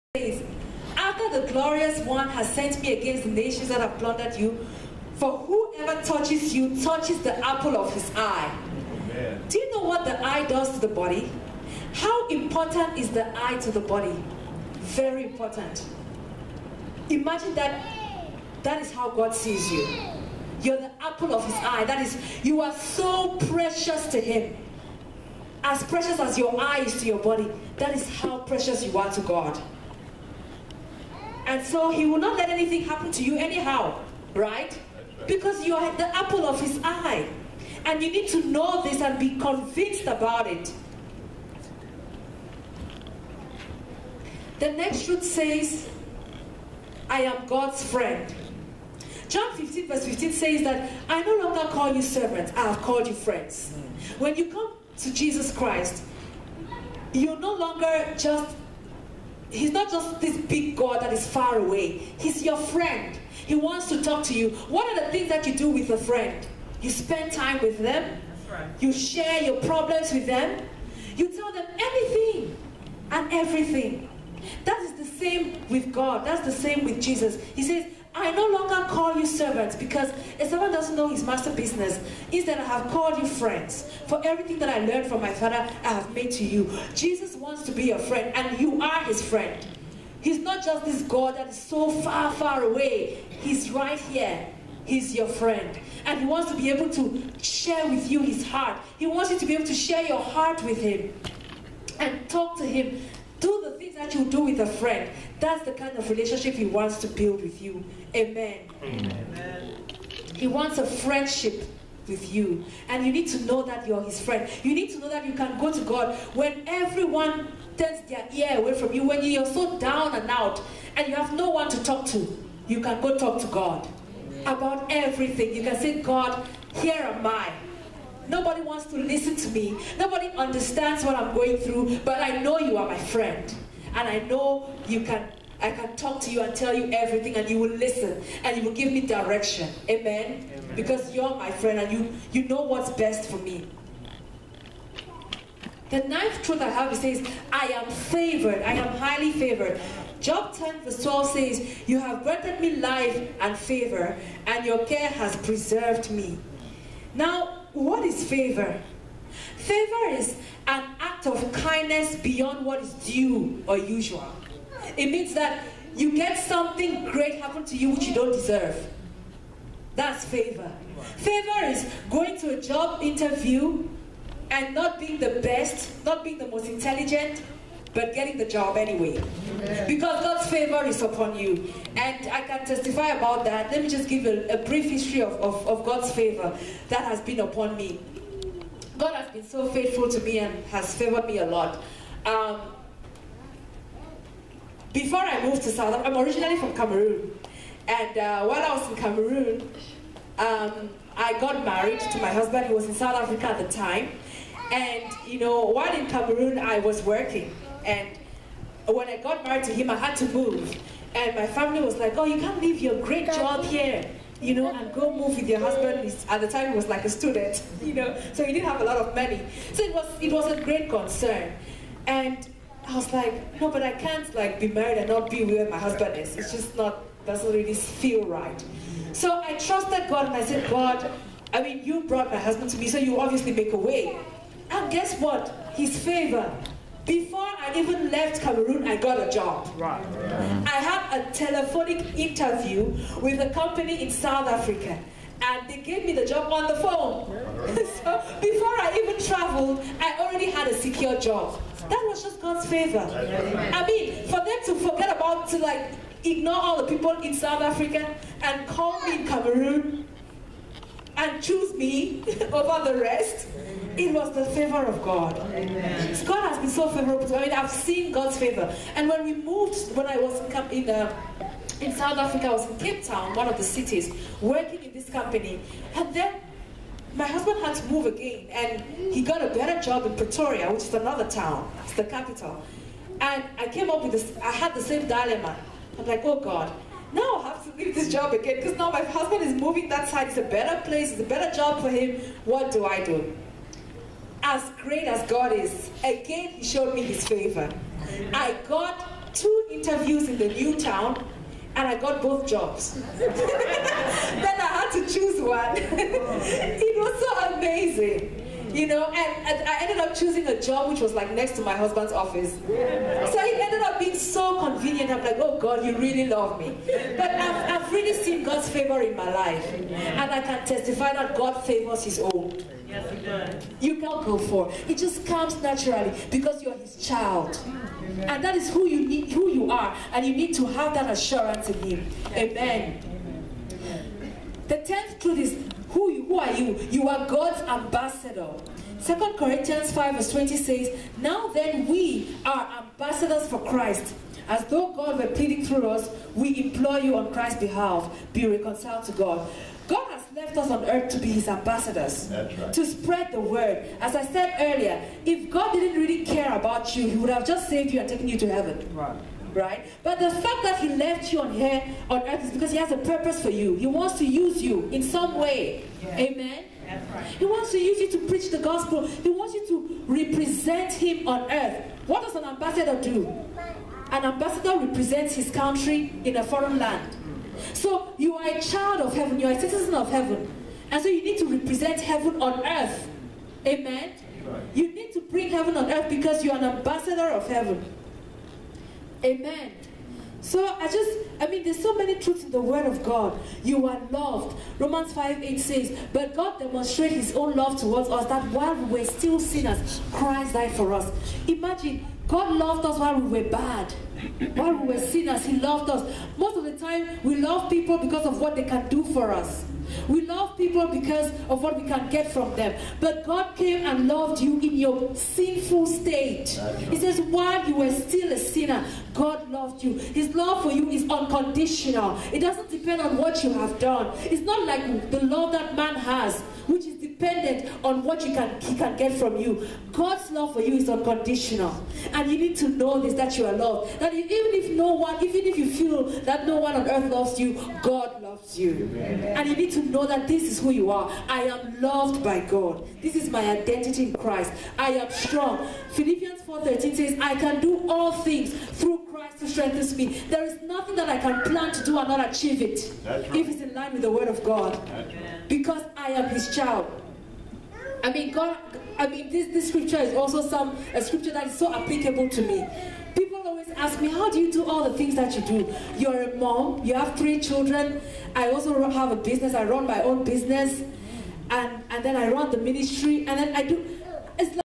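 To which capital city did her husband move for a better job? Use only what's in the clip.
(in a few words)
Pretoria.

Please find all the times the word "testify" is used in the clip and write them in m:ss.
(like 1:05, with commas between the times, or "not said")
3:02, 5:20.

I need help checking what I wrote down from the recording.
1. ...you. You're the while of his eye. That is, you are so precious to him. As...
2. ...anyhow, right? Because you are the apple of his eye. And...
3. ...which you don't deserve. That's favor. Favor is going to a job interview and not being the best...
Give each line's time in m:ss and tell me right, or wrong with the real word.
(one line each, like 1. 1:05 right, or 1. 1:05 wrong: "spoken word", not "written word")
1. 0:19 wrong: "apple", not "while"
2. 0:33 right
3. 2:47 right.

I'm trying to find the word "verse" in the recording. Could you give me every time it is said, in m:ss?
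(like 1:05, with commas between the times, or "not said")
0:49, 2:30, 5:40.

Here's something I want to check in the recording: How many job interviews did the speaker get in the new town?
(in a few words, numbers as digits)
2.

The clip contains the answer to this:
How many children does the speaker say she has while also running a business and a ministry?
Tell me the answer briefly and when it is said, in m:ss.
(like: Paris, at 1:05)
3, at 7:47.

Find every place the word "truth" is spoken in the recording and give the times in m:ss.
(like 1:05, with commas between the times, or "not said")
0:45, 2:26, 5:35, 6:32.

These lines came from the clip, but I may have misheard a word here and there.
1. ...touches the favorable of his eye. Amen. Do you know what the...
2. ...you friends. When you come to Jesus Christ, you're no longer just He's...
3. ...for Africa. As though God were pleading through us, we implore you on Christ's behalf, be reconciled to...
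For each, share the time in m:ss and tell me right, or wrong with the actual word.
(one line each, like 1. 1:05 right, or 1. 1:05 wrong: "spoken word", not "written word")
1. 0:06 wrong: "apple", not "favorable"
2. 0:53 right
3. 5:43 wrong: "Christ", not "Africa".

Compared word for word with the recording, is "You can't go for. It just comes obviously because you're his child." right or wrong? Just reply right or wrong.
wrong.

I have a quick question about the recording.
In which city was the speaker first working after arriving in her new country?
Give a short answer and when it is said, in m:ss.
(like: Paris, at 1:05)
Cape Town, at 4:32.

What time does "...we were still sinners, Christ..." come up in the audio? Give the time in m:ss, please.
6:38.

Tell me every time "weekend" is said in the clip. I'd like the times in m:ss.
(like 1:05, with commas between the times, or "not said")
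not said.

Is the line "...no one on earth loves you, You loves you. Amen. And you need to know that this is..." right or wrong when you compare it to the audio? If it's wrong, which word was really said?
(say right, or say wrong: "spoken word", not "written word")
wrong: "God", not "You".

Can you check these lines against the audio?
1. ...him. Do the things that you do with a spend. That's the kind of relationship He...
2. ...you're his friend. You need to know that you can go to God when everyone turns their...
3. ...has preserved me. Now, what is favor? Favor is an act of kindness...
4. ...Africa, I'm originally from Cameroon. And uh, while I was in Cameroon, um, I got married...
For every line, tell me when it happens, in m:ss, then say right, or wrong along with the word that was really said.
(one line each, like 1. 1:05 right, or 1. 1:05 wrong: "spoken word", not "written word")
1. 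1:42 wrong: "friend", not "spend"
2. 1:53 right
3. 2:35 right
4. 3:15 right.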